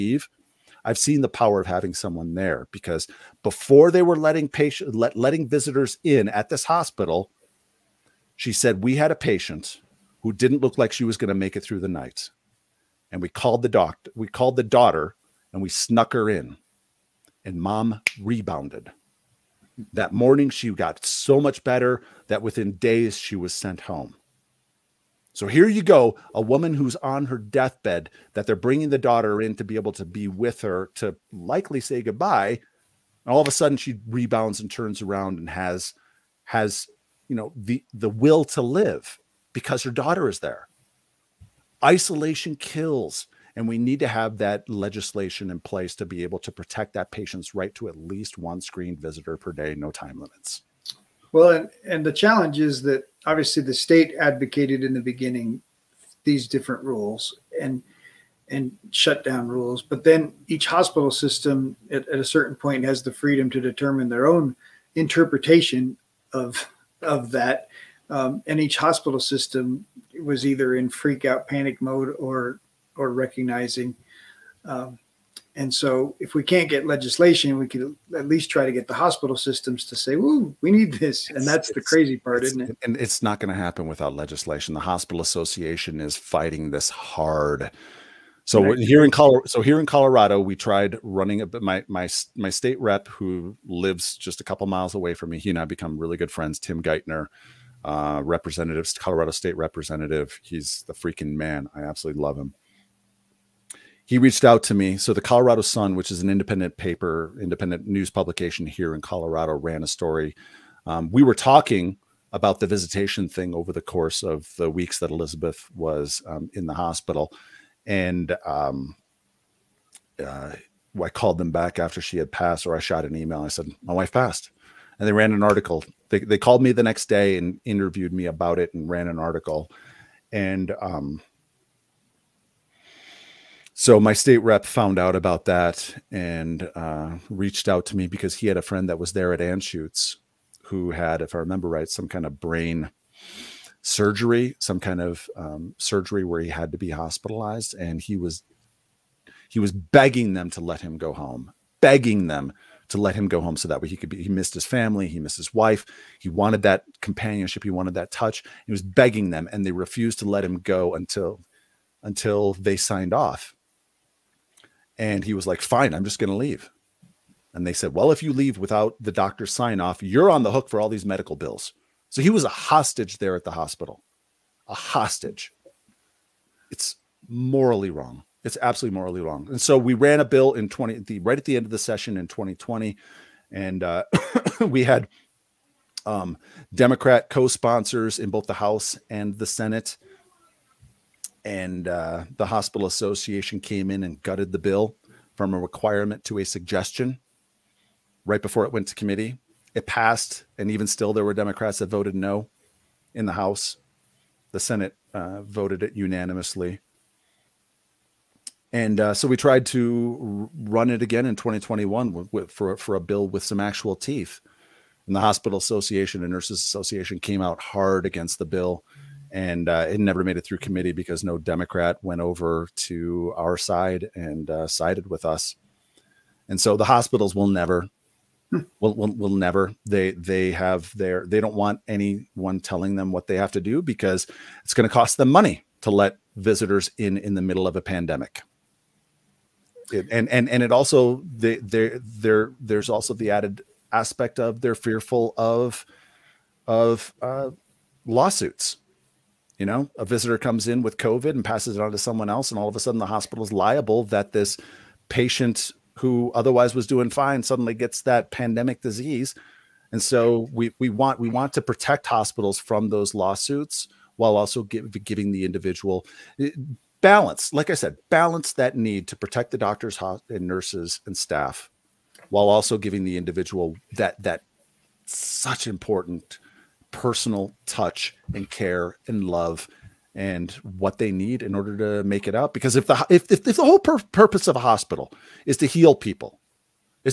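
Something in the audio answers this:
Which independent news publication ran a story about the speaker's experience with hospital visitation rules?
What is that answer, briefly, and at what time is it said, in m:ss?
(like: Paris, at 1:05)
The Colorado Sun, at 1:45.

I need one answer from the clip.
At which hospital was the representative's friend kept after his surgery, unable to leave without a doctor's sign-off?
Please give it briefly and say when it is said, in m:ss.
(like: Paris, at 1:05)
Anschutz, at 2:19.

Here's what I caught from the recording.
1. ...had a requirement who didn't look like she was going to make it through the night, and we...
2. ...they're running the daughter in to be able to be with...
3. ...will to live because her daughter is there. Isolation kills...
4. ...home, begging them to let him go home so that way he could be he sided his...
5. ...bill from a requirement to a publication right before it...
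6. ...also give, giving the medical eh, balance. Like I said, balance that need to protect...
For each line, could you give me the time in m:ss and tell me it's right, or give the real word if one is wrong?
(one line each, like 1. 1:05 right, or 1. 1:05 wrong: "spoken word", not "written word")
1. 0:08 wrong: "patient", not "requirement"
2. 0:28 wrong: "bringing", not "running"
3. 0:38 right
4. 2:31 wrong: "missed", not "sided"
5. 3:14 wrong: "suggestion", not "publication"
6. 4:24 wrong: "individual", not "medical".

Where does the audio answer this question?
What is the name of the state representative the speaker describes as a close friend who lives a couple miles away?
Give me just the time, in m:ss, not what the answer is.
1:36.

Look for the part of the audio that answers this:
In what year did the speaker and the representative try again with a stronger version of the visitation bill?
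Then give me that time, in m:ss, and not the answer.
3:31.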